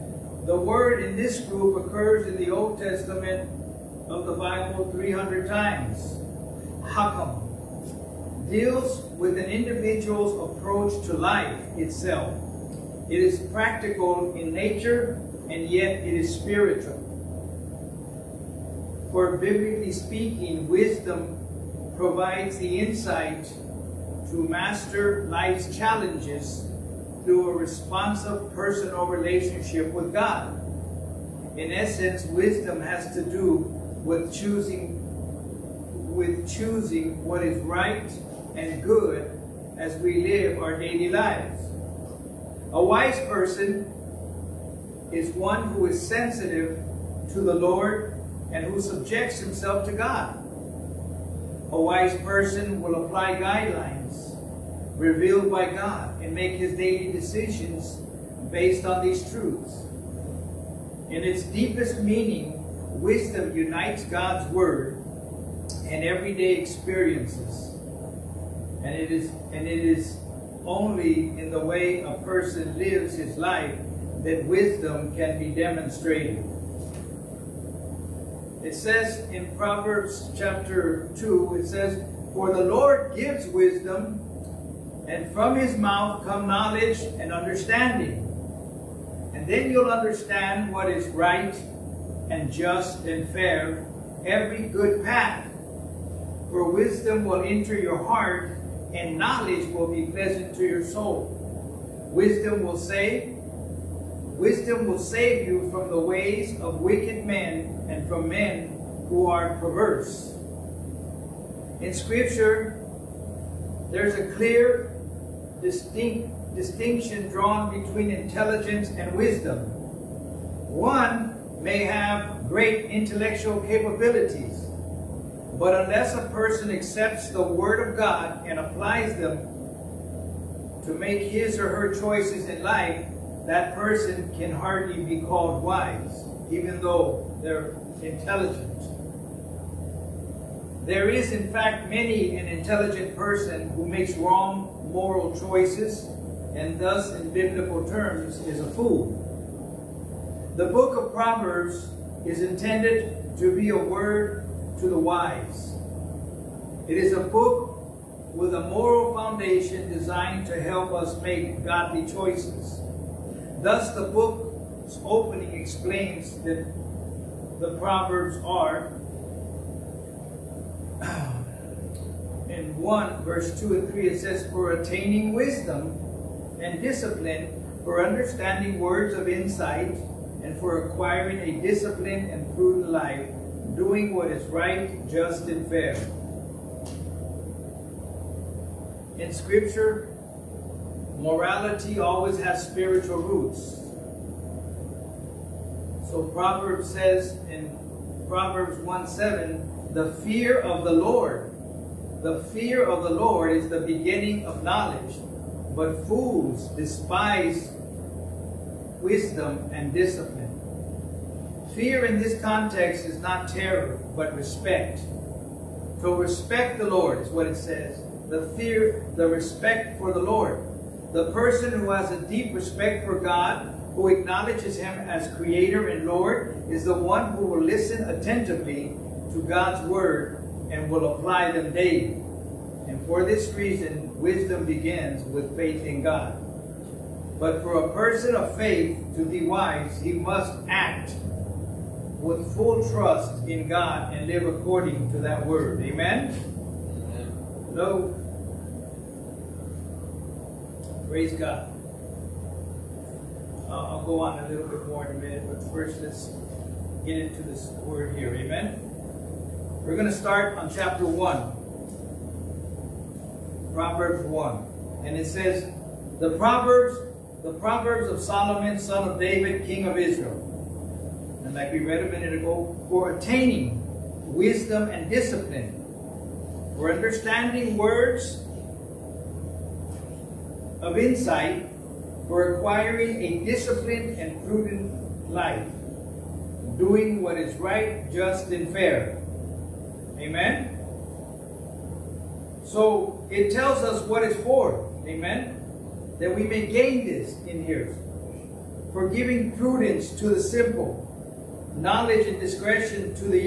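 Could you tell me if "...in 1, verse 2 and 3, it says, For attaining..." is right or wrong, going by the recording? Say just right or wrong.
right.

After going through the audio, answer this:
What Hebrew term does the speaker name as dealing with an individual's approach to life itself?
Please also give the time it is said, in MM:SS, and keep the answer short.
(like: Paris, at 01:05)
Hakam, at 00:06.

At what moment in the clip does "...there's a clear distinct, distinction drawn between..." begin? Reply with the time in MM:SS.
01:53.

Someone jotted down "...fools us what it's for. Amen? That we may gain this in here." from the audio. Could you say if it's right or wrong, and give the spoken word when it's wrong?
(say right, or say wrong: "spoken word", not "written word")
wrong: "tells", not "fools".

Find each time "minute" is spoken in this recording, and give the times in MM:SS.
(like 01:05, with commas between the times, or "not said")
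04:15, 04:32.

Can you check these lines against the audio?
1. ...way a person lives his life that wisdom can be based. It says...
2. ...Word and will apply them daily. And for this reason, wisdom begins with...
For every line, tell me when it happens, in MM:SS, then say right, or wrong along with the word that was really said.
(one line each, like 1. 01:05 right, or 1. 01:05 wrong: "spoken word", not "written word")
1. 01:11 wrong: "demonstrated", not "based"
2. 03:49 right.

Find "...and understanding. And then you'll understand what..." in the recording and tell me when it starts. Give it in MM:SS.
01:26.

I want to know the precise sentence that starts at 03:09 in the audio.
In Scripture, morality always has spiritual roots.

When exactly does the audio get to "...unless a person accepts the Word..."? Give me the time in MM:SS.
02:05.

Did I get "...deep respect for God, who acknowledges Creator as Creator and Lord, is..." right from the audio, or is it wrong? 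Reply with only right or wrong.
wrong.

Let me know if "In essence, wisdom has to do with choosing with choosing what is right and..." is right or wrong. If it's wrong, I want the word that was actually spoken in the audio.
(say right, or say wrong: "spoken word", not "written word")
right.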